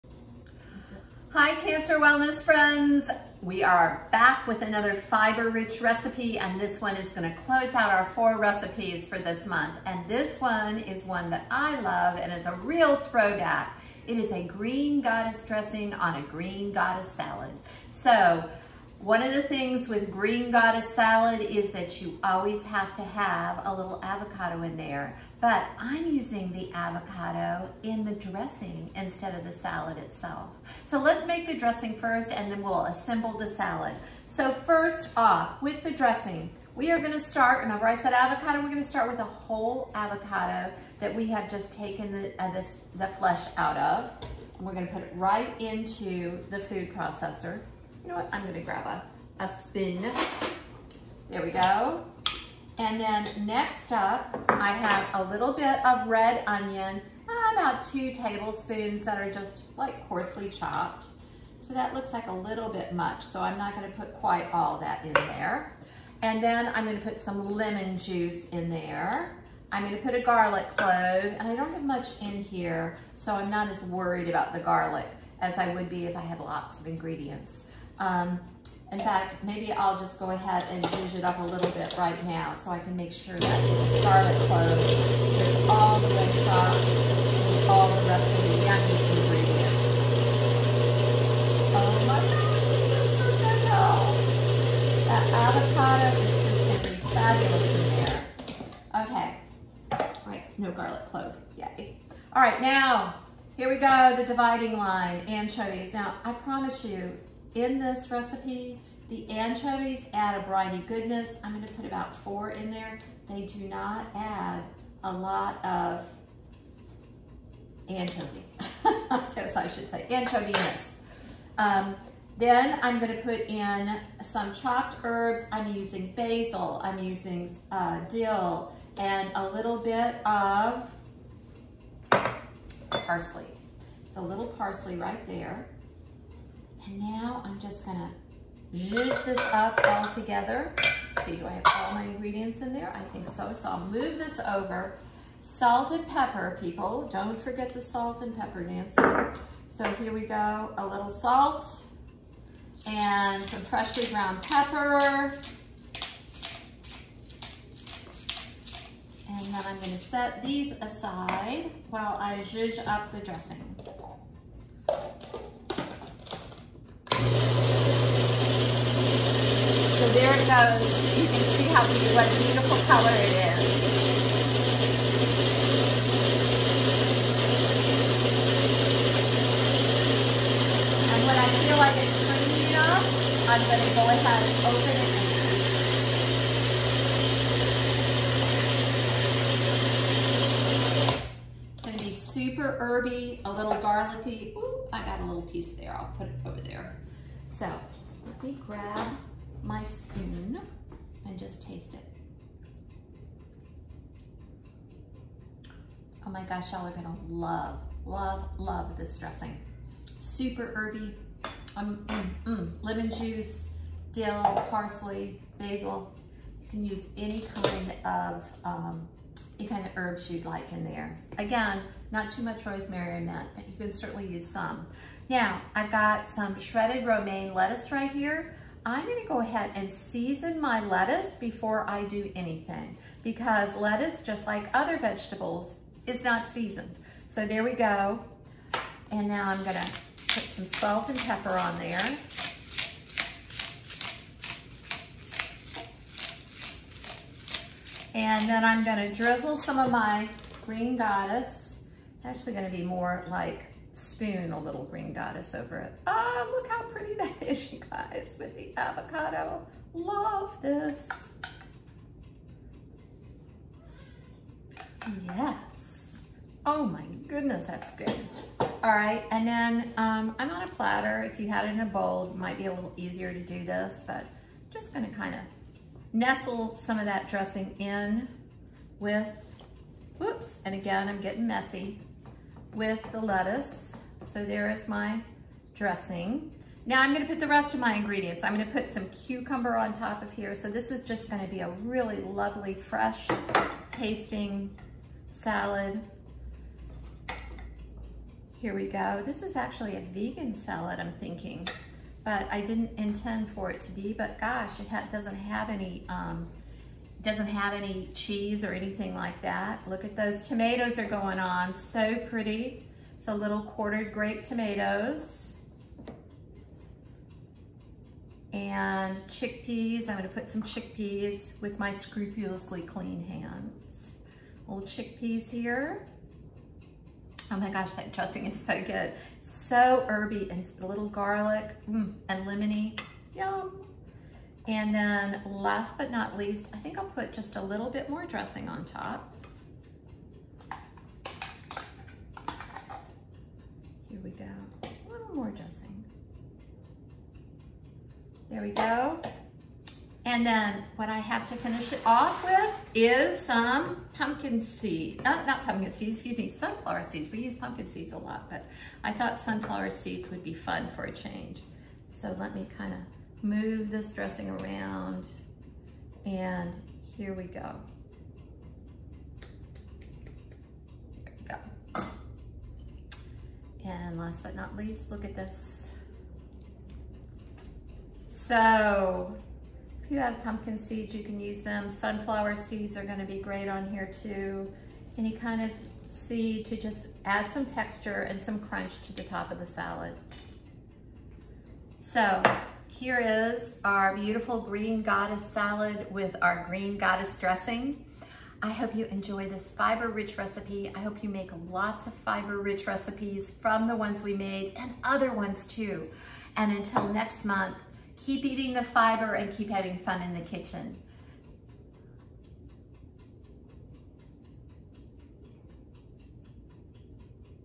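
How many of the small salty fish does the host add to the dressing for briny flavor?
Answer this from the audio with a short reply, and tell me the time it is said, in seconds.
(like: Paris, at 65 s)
4, at 111 s.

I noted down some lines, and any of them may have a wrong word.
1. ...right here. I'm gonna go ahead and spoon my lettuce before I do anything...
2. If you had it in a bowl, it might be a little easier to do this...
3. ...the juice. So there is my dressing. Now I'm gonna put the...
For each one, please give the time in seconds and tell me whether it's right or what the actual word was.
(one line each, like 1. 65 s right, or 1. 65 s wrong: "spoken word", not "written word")
1. 227 s wrong: "season", not "spoon"
2. 271 s right
3. 283 s wrong: "lettuce", not "juice".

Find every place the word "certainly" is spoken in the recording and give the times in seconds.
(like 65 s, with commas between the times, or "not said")
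223 s.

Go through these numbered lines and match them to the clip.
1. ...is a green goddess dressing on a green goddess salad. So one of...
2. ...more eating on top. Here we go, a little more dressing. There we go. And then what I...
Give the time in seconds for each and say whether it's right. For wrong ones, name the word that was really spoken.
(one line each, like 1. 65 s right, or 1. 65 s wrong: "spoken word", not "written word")
1. 14 s right
2. 338 s wrong: "dressing", not "eating".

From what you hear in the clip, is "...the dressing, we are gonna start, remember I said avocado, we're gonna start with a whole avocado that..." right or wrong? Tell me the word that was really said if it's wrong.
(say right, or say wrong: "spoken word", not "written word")
right.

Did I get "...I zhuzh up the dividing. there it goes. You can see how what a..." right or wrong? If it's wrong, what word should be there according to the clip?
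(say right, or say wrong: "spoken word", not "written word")
wrong: "dressing", not "dividing".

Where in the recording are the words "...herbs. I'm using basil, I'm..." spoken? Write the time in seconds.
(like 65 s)
125 s.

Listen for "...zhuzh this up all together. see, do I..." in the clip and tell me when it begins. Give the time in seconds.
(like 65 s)
138 s.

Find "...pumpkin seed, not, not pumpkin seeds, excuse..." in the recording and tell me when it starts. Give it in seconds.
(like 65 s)
354 s.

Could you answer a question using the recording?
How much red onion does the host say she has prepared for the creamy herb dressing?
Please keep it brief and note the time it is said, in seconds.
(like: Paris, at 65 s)
2 tablespoons, at 57 s.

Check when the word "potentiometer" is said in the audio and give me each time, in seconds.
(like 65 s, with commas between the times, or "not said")
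not said.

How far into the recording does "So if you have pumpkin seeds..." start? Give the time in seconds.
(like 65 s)
378 s.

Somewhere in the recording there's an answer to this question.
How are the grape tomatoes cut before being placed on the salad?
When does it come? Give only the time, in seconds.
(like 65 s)
313 s.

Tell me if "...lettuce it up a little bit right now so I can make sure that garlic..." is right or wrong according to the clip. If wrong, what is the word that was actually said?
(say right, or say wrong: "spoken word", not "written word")
wrong: "juice", not "lettuce".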